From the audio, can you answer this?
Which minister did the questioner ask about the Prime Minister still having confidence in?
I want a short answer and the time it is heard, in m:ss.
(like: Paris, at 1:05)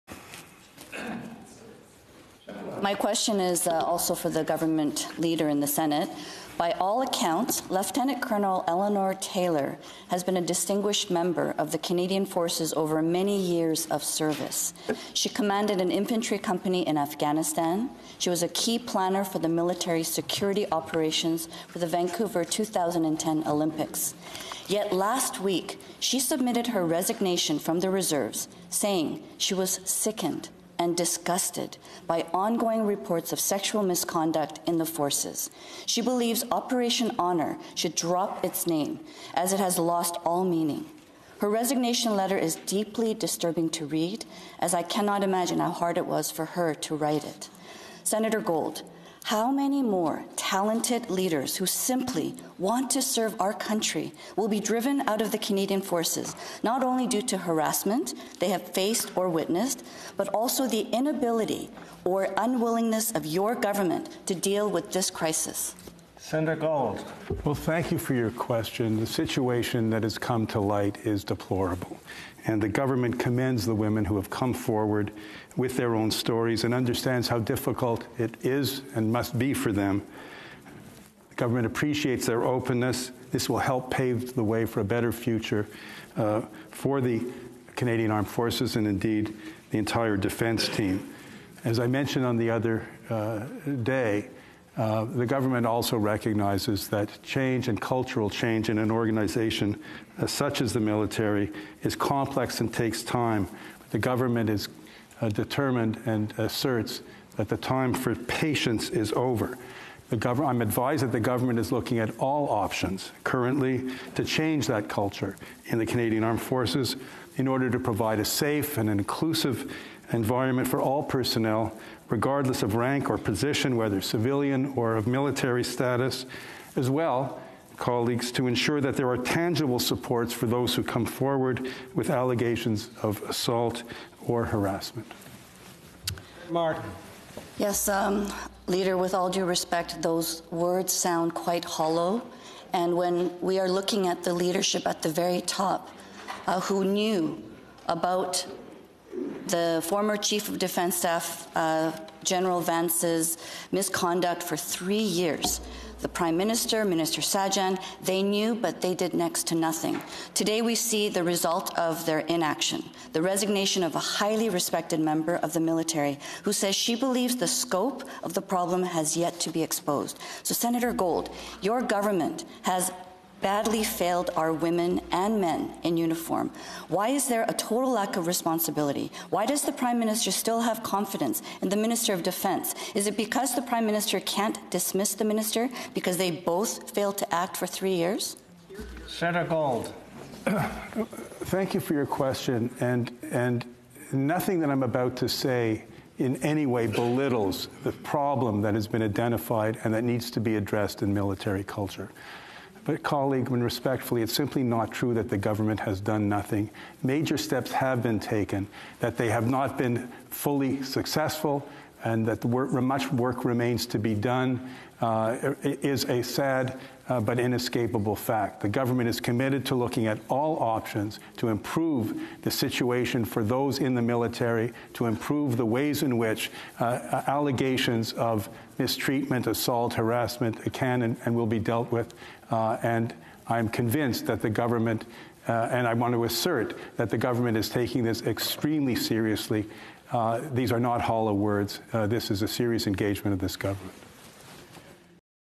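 Minister Sajjan, at 2:36.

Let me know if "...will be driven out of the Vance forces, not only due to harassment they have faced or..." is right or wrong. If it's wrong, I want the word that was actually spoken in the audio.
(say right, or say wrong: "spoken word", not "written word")
wrong: "Canadian", not "Vance".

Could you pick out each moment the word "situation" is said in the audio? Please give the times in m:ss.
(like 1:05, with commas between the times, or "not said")
1:09, 3:42.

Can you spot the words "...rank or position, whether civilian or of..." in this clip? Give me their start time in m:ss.
2:02.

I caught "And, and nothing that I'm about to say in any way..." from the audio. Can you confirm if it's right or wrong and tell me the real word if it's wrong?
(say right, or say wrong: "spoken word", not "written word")
right.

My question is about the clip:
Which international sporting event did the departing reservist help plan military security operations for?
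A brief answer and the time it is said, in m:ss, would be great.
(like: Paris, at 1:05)
Vancouver 2010 Olympics, at 0:21.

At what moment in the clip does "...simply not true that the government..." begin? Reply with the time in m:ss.
3:24.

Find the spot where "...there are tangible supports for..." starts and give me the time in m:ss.
2:08.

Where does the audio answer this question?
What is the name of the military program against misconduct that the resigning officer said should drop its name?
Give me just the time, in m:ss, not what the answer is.
0:36.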